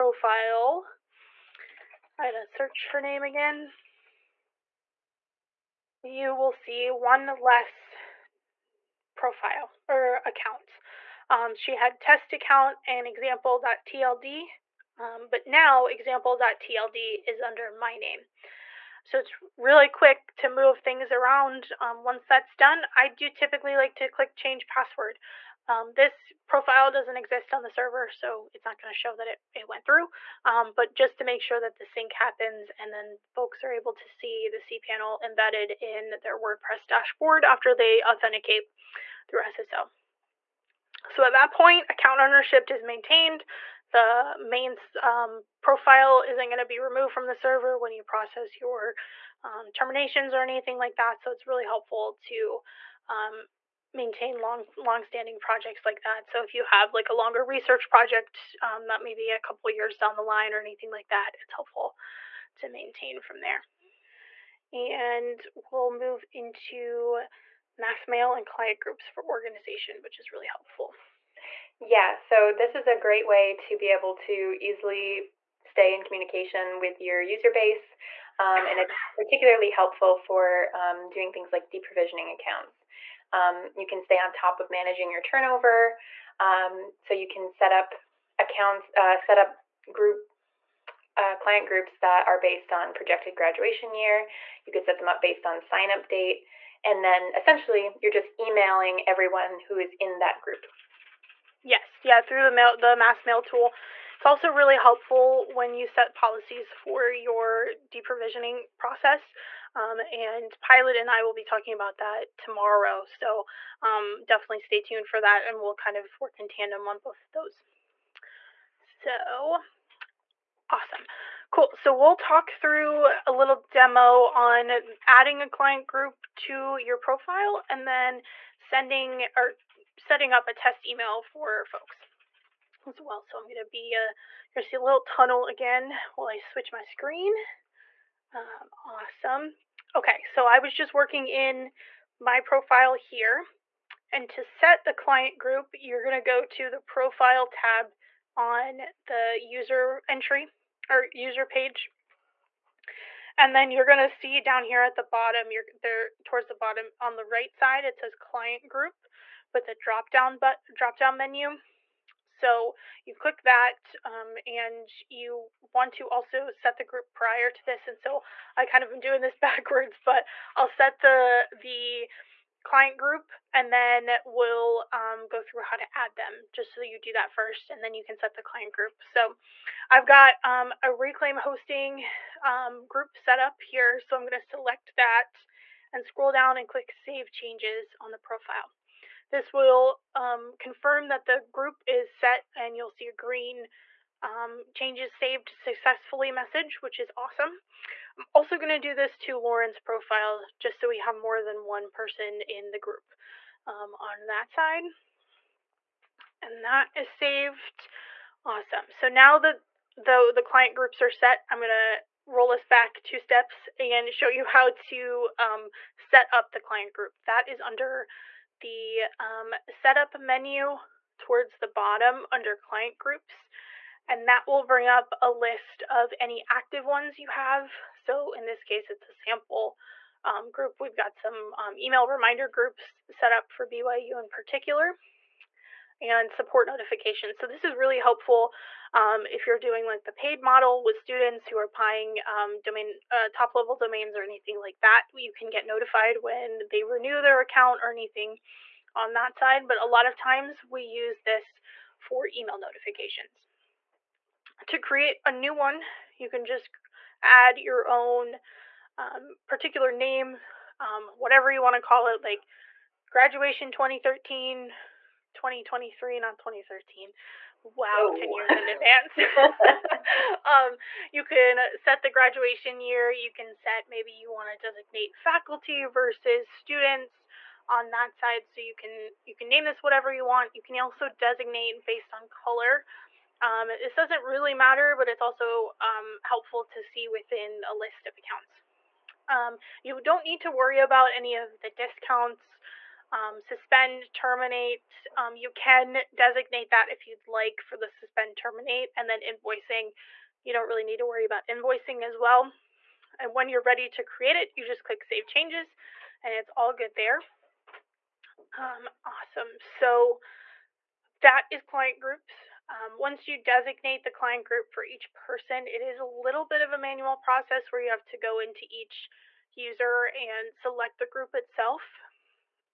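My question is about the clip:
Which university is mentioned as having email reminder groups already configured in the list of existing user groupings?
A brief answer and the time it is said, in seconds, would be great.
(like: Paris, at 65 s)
BYU, at 233 s.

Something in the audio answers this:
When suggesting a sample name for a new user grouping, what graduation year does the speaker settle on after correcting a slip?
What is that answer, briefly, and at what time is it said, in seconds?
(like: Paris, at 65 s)
2023, at 265 s.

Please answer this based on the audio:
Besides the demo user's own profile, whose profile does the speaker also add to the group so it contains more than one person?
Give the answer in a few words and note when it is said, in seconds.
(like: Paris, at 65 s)
Lauren, at 199 s.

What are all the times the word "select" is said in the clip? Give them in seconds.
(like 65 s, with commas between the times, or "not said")
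184 s, 320 s.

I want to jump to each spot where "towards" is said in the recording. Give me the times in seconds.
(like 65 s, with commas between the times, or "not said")
156 s, 221 s.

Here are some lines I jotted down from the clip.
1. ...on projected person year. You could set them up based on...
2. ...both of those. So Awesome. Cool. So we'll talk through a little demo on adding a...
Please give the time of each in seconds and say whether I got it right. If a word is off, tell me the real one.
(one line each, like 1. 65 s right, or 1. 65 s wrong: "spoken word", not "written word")
1. 92 s wrong: "graduation", not "person"
2. 116 s right.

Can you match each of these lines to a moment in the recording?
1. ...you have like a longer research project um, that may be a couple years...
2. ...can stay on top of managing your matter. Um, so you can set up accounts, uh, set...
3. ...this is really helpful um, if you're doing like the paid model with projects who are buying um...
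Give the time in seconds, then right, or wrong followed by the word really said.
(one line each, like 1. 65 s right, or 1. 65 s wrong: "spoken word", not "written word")
1. 56 s right
2. 83 s wrong: "turnover", not "matter"
3. 237 s wrong: "students", not "projects".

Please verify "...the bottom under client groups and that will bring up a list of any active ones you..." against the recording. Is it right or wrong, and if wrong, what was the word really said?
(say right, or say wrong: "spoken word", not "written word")
right.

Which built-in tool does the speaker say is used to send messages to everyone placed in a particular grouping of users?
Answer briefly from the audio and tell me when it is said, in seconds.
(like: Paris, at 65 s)
mass mail tool, at 102 s.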